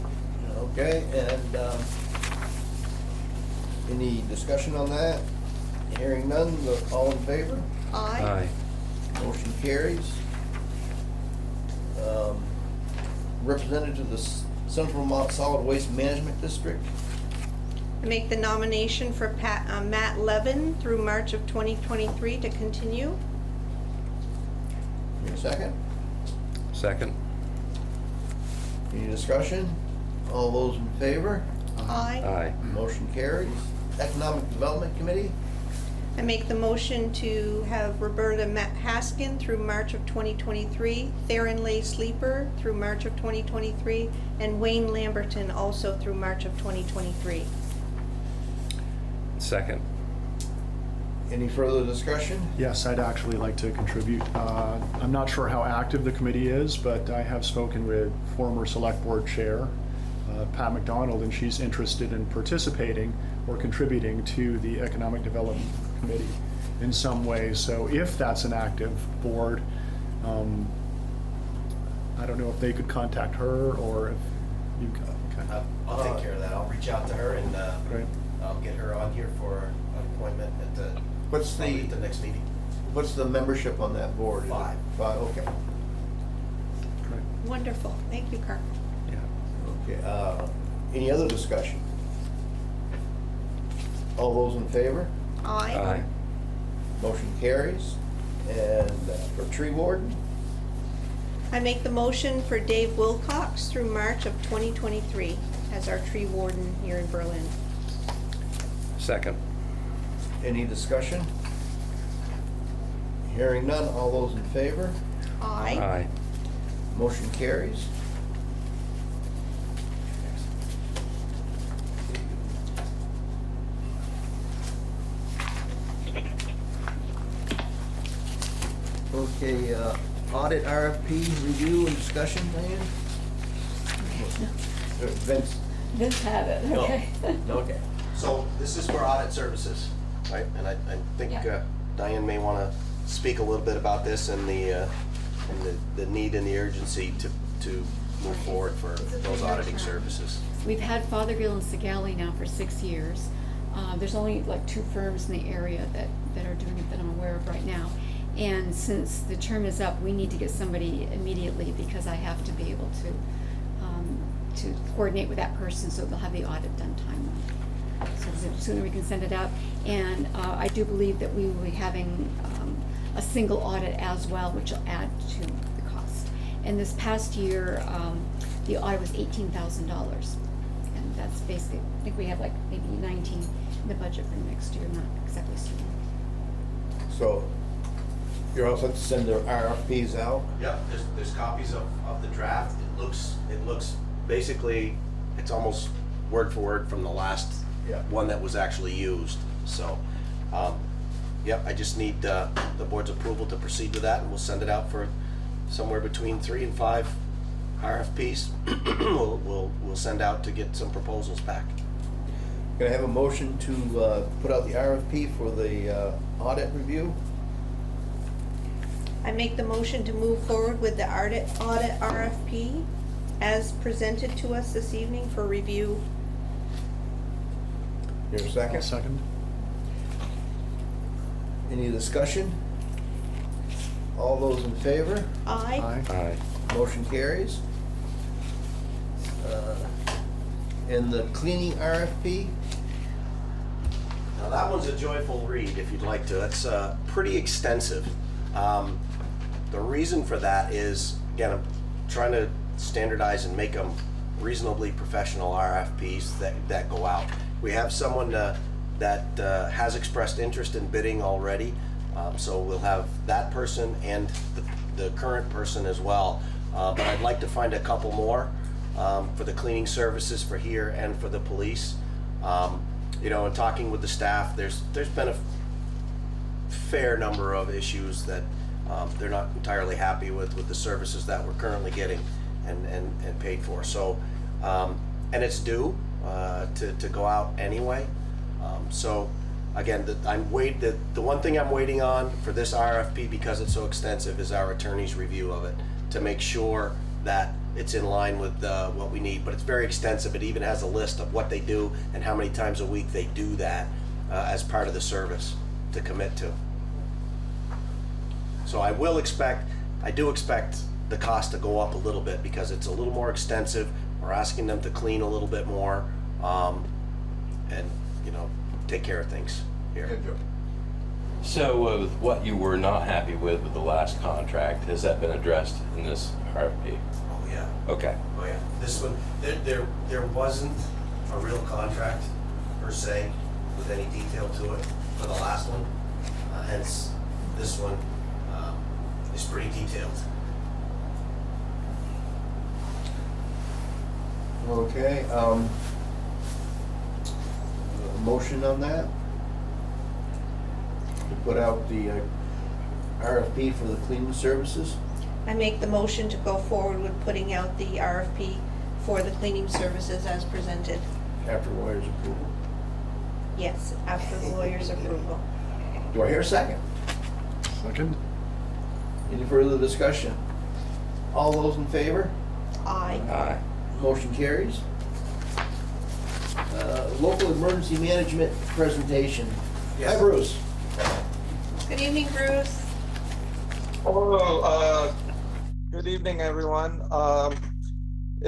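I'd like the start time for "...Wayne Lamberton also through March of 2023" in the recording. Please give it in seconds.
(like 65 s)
44 s.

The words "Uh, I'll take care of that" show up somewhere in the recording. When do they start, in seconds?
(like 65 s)
75 s.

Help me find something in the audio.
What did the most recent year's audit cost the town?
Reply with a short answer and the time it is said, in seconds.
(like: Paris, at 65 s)
$18,000, at 179 s.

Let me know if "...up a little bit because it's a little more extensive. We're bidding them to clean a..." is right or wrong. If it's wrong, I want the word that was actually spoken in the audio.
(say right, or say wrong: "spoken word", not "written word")
wrong: "asking", not "bidding".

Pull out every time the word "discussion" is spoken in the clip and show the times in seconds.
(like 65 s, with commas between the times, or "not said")
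4 s, 29 s, 51 s, 91 s, 110 s, 131 s, 231 s, 369 s.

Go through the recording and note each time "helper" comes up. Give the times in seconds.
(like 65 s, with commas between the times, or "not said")
not said.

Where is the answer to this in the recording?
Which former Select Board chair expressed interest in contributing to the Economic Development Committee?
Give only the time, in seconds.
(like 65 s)
60 s.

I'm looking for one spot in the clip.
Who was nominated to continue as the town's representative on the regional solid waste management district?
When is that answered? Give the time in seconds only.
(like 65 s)
19 s.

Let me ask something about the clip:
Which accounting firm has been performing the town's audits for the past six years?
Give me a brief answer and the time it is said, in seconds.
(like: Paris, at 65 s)
Fothergill and Segale, at 151 s.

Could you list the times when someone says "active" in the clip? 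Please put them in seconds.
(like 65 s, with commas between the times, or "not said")
55 s, 68 s.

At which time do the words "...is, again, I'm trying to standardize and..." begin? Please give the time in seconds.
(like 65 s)
250 s.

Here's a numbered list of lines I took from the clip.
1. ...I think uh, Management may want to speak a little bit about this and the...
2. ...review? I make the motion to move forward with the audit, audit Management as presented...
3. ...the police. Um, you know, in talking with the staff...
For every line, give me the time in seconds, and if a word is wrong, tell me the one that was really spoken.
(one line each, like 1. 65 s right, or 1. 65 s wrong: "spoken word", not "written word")
1. 140 s wrong: "Diane", not "Management"
2. 216 s wrong: "RFP", not "Management"
3. 271 s right.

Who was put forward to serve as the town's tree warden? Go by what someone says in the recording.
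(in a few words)
Dave Wilcox.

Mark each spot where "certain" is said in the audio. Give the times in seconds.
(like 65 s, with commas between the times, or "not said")
185 s.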